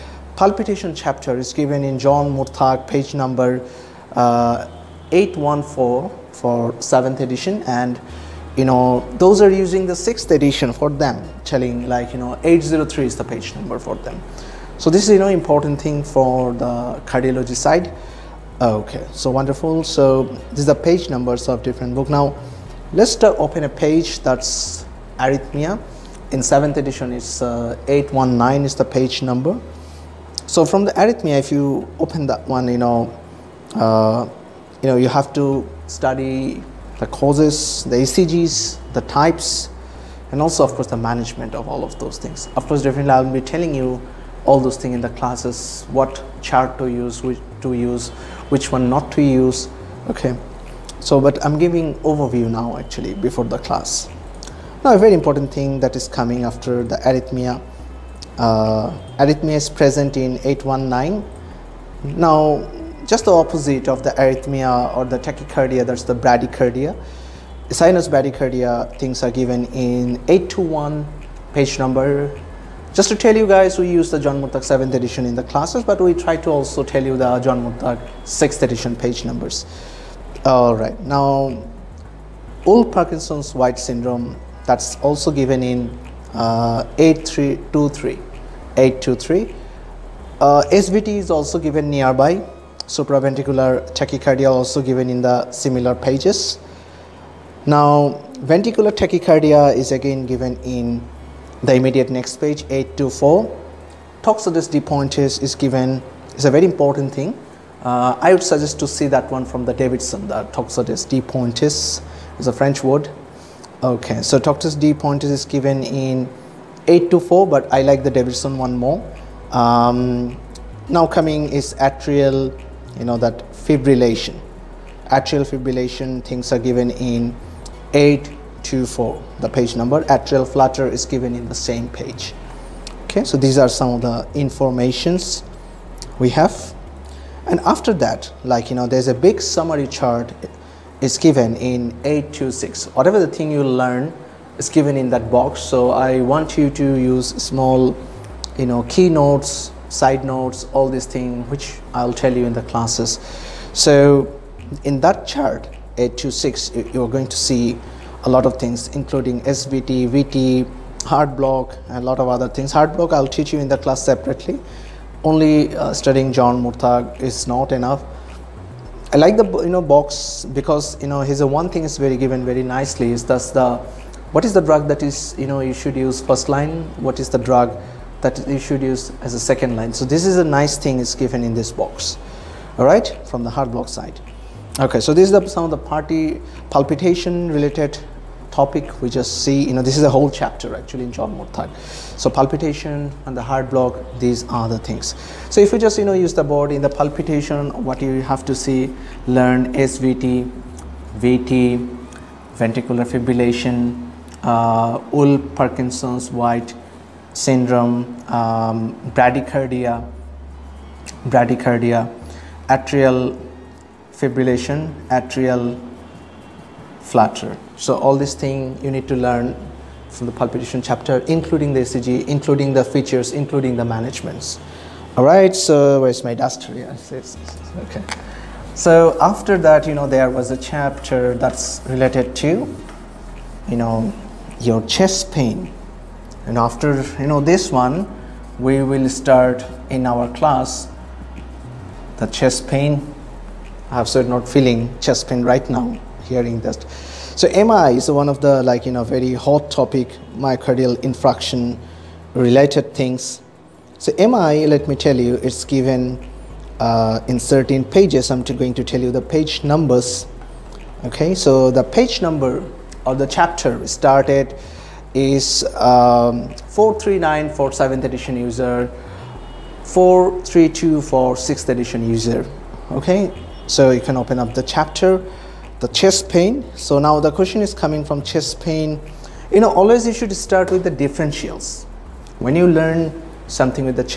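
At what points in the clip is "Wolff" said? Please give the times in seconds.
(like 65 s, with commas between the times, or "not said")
82 s, 205 s.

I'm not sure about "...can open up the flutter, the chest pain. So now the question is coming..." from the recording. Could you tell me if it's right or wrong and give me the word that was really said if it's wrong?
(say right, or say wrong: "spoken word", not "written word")
wrong: "chapter", not "flutter".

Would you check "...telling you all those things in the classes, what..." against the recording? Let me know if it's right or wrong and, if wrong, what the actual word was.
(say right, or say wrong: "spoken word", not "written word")
right.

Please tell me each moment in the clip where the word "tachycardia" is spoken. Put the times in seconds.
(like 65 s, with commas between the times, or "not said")
65 s, 93 s, 99 s.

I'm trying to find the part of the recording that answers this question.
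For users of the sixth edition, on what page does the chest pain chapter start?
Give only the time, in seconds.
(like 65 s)
269 s.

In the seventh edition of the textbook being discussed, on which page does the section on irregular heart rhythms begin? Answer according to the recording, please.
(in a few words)
819.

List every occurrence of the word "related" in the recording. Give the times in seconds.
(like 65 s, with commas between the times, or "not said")
187 s, 231 s, 252 s.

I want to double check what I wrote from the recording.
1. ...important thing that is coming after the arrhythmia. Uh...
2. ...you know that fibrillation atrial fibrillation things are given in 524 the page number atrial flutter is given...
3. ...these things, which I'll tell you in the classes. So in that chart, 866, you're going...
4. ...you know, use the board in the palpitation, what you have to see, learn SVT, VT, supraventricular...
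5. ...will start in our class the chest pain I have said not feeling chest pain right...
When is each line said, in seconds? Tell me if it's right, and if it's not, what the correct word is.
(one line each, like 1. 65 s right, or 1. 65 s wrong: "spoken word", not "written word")
1. 55 s right
2. 123 s wrong: "824", not "524"
3. 150 s wrong: "826", not "866"
4. 195 s wrong: "ventricular", not "supraventricular"
5. 238 s right.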